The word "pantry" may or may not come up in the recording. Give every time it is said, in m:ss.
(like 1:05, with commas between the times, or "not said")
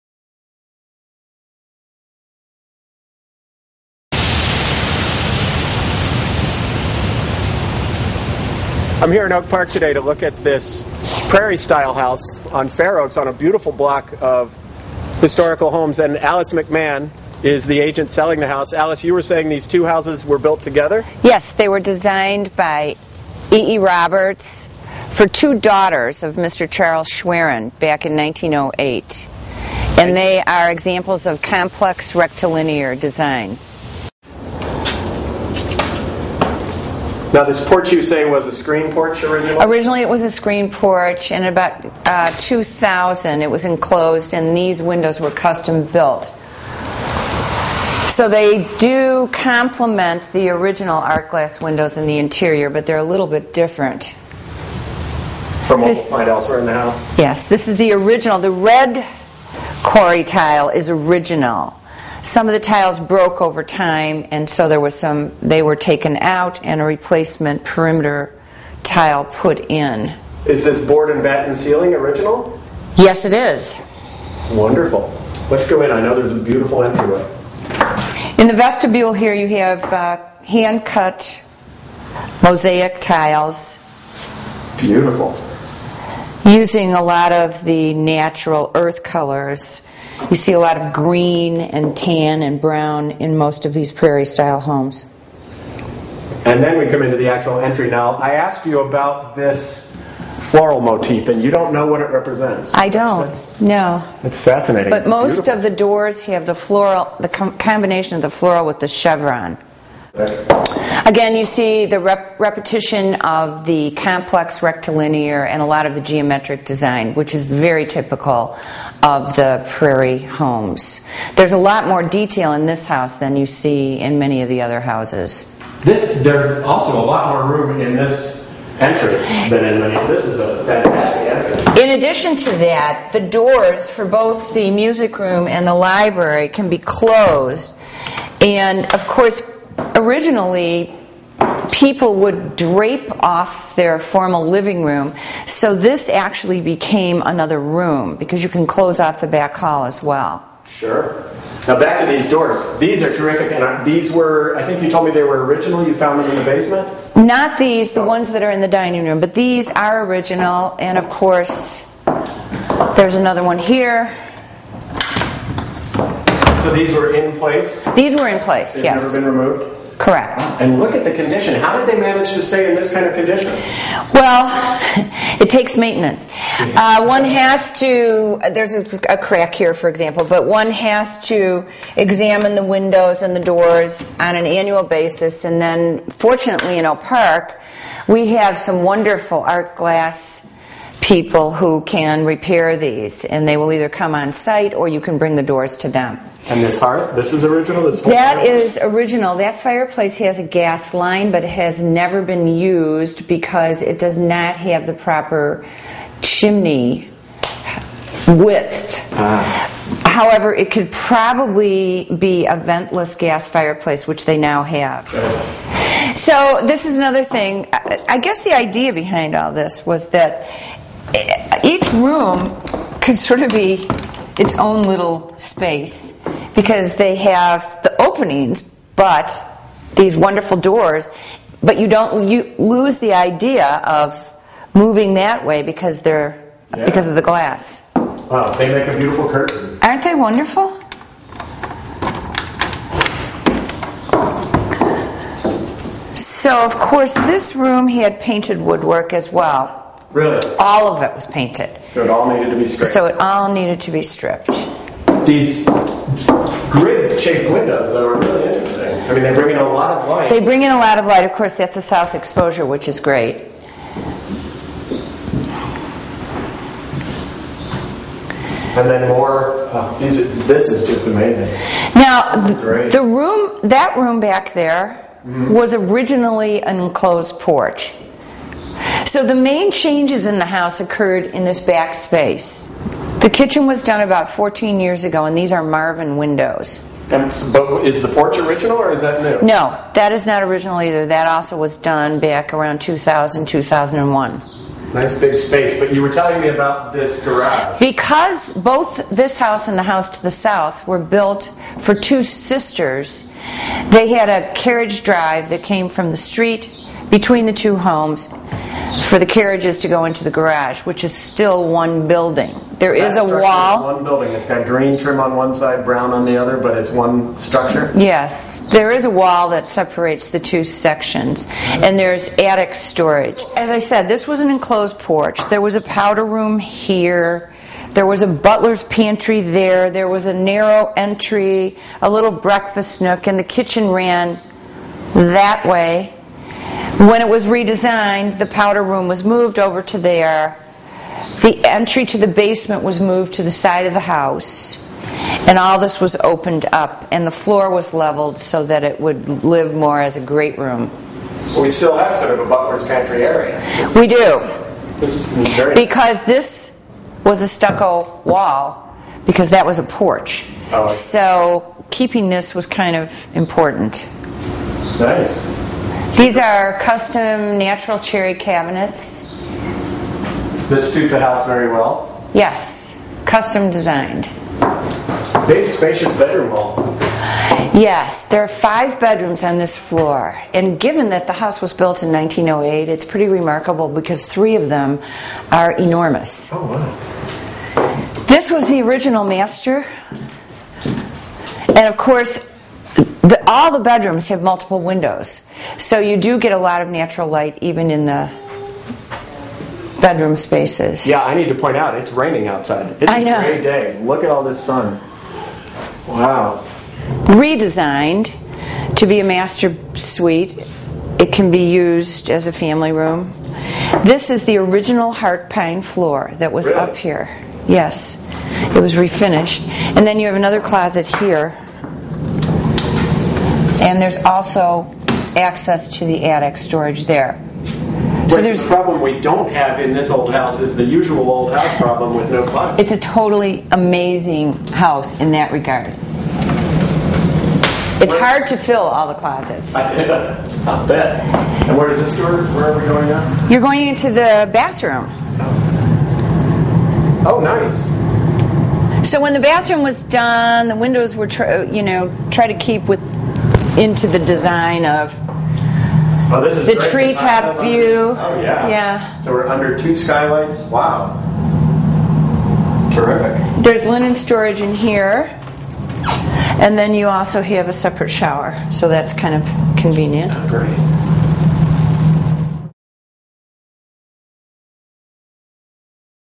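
5:28, 5:52.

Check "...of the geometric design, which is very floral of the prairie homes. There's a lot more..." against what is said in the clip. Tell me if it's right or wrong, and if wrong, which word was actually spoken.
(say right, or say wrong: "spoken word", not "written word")
wrong: "typical", not "floral".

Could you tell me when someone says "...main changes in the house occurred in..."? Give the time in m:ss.
4:39.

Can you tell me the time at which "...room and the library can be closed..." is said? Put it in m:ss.
2:15.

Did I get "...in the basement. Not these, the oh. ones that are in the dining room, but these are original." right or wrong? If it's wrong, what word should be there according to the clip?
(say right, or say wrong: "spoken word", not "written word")
right.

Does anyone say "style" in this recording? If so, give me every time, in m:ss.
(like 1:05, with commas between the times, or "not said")
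0:11, 1:34.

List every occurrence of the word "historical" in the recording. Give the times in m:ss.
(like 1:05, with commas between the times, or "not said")
0:15.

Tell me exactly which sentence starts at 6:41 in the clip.
Yeah, I need to point out it's raining outside.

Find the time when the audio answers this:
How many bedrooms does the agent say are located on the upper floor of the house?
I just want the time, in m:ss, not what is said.
6:18.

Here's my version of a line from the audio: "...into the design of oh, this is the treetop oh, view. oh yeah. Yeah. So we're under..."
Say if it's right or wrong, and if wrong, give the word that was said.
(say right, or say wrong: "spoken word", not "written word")
right.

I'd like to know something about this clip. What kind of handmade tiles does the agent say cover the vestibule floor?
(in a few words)
Mosaic tiles.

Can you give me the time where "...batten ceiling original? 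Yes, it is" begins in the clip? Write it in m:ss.
1:11.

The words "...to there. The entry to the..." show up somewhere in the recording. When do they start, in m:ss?
5:39.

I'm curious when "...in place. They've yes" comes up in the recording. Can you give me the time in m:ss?
2:48.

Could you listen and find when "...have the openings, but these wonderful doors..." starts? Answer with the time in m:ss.
3:47.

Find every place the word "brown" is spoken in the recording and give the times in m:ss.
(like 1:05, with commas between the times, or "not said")
1:32, 5:15.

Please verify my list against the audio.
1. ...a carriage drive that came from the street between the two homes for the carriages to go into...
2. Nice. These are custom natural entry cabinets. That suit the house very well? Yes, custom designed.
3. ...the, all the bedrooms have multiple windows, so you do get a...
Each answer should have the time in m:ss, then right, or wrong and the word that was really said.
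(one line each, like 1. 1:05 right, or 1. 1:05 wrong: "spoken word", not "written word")
1. 5:04 right
2. 6:04 wrong: "cherry", not "entry"
3. 6:33 right.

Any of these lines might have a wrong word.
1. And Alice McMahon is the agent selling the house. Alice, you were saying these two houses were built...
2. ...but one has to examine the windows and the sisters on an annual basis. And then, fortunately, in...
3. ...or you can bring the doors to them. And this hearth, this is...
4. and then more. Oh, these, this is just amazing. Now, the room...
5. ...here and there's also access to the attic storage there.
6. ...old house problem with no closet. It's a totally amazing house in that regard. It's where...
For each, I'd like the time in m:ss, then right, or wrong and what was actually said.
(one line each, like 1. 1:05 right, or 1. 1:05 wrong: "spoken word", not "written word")
1. 0:15 right
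2. 3:00 wrong: "doors", not "sisters"
3. 3:14 right
4. 4:28 right
5. 7:01 right
6. 7:11 right.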